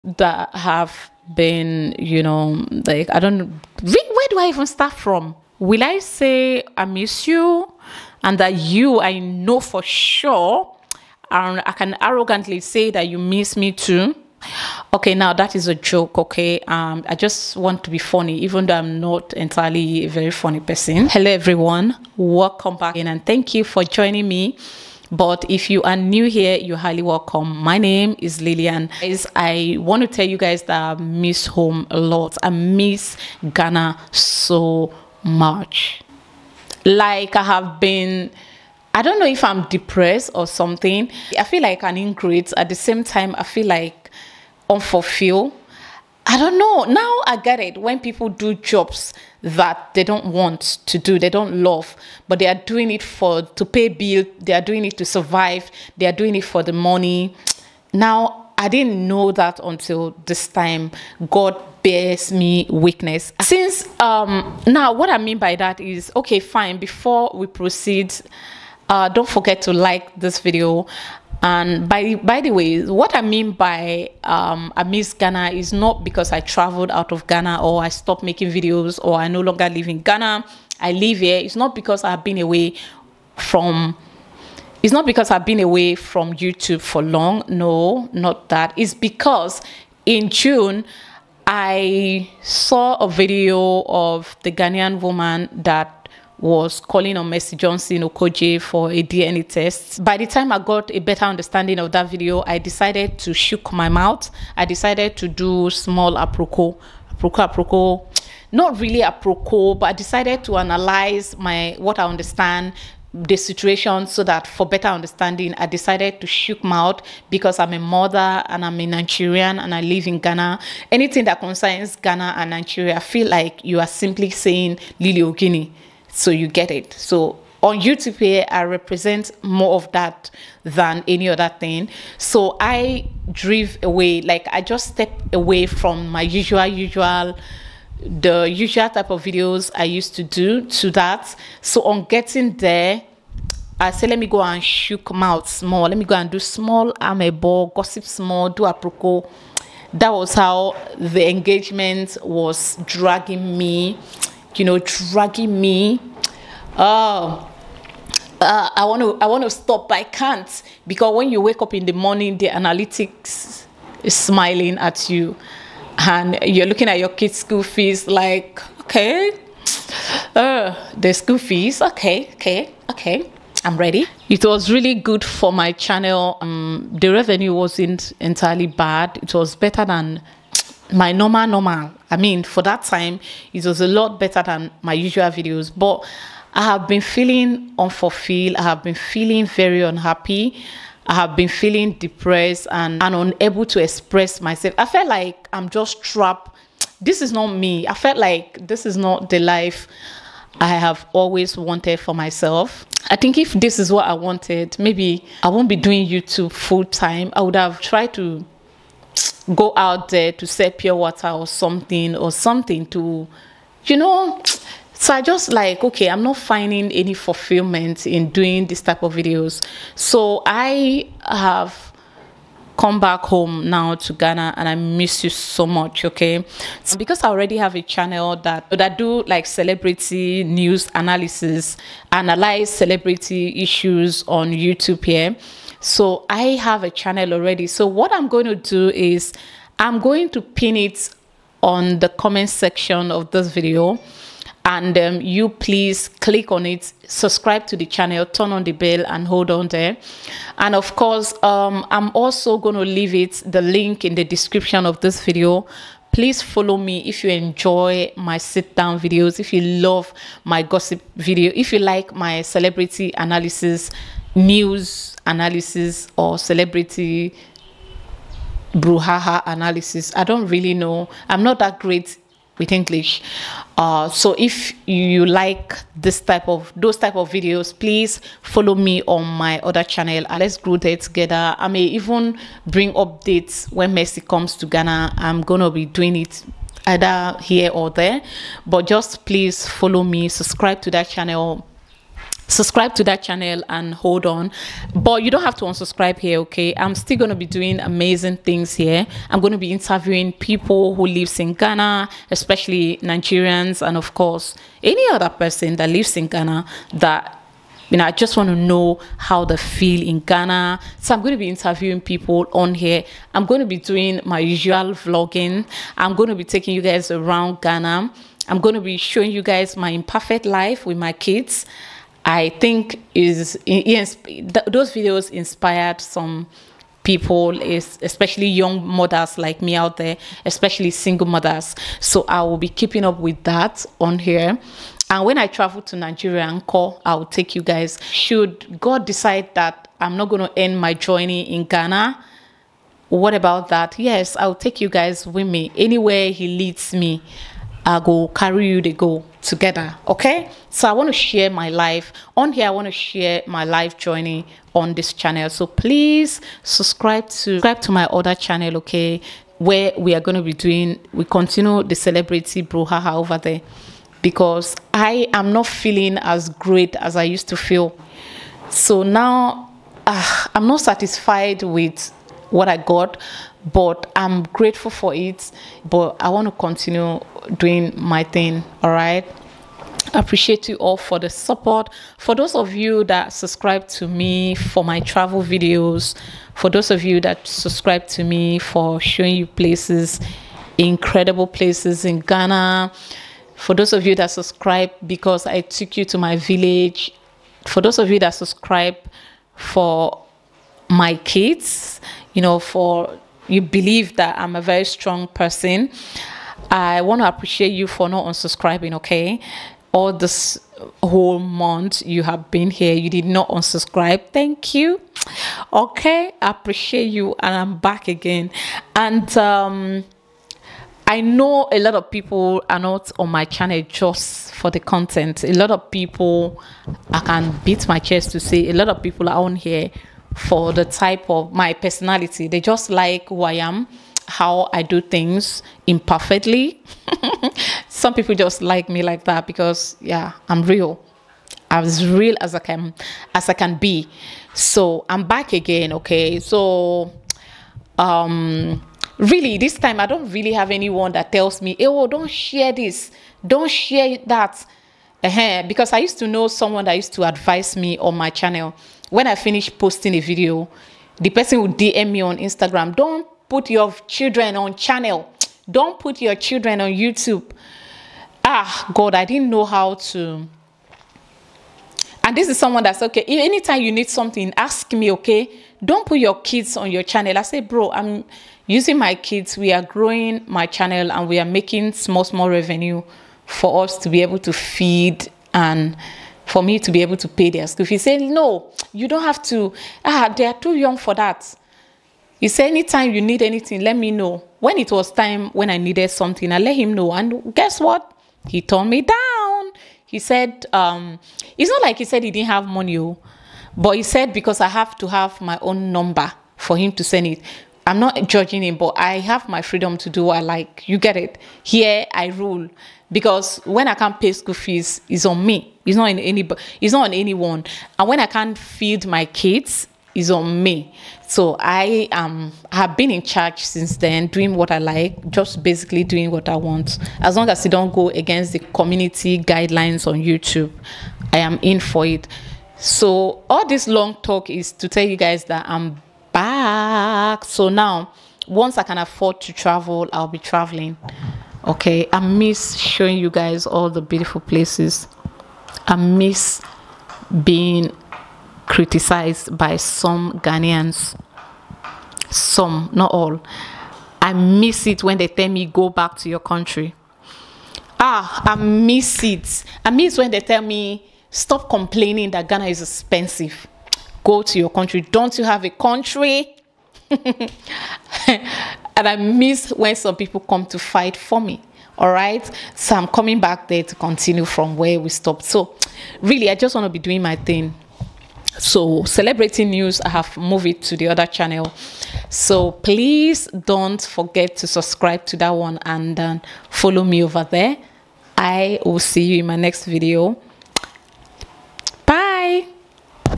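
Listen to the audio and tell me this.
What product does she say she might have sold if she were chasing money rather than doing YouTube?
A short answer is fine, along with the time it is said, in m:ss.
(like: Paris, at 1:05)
pure water, at 3:30.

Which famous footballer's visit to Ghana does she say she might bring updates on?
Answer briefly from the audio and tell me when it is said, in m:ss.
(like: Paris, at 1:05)
Messi, at 4:43.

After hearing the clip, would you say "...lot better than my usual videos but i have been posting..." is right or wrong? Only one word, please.
wrong.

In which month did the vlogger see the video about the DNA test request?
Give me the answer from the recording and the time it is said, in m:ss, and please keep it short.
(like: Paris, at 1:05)
June, at 1:30.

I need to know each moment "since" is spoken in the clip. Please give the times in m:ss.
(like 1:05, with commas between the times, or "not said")
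1:03, 8:43.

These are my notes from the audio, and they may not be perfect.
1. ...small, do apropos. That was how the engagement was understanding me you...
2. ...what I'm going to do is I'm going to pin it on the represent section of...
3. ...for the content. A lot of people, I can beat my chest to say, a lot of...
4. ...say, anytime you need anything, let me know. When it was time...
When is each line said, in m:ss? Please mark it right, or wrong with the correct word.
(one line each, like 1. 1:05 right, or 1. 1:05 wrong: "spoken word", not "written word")
1. 2:28 wrong: "dragging", not "understanding"
2. 3:57 wrong: "comment", not "represent"
3. 7:04 right
4. 8:12 right.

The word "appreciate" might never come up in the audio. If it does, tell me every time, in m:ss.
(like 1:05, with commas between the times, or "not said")
6:20, 6:47, 6:56.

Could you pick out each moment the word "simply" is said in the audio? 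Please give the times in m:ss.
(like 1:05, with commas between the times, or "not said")
2:03.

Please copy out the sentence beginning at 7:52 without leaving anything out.
And this is someone that's okay.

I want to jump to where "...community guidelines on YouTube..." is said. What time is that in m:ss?
8:48.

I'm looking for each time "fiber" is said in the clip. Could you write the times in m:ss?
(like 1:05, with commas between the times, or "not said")
not said.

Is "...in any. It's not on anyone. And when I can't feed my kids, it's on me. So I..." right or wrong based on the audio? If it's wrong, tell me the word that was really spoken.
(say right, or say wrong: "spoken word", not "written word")
right.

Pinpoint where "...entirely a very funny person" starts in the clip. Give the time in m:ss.
0:19.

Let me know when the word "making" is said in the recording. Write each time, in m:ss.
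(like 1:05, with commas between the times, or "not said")
1:18, 8:01.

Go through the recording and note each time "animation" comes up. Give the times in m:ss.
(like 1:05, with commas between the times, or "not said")
not said.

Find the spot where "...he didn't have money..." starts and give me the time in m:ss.
8:22.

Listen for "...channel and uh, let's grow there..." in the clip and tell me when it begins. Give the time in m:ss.
4:39.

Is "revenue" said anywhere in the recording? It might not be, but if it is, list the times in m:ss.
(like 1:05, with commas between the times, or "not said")
2:57, 8:02.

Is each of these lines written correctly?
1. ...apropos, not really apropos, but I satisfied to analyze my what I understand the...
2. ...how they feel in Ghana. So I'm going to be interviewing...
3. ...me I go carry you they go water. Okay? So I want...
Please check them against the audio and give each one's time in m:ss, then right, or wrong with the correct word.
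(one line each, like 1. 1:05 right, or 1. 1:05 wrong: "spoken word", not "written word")
1. 1:47 wrong: "decided", not "satisfied"
2. 5:09 right
3. 5:46 wrong: "together", not "water".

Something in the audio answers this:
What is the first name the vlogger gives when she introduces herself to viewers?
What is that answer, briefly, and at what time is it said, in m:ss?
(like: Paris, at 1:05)
Lillian, at 0:28.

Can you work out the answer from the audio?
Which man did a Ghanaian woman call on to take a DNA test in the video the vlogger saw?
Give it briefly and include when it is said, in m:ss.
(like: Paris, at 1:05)
Johnson Okoje, at 1:37.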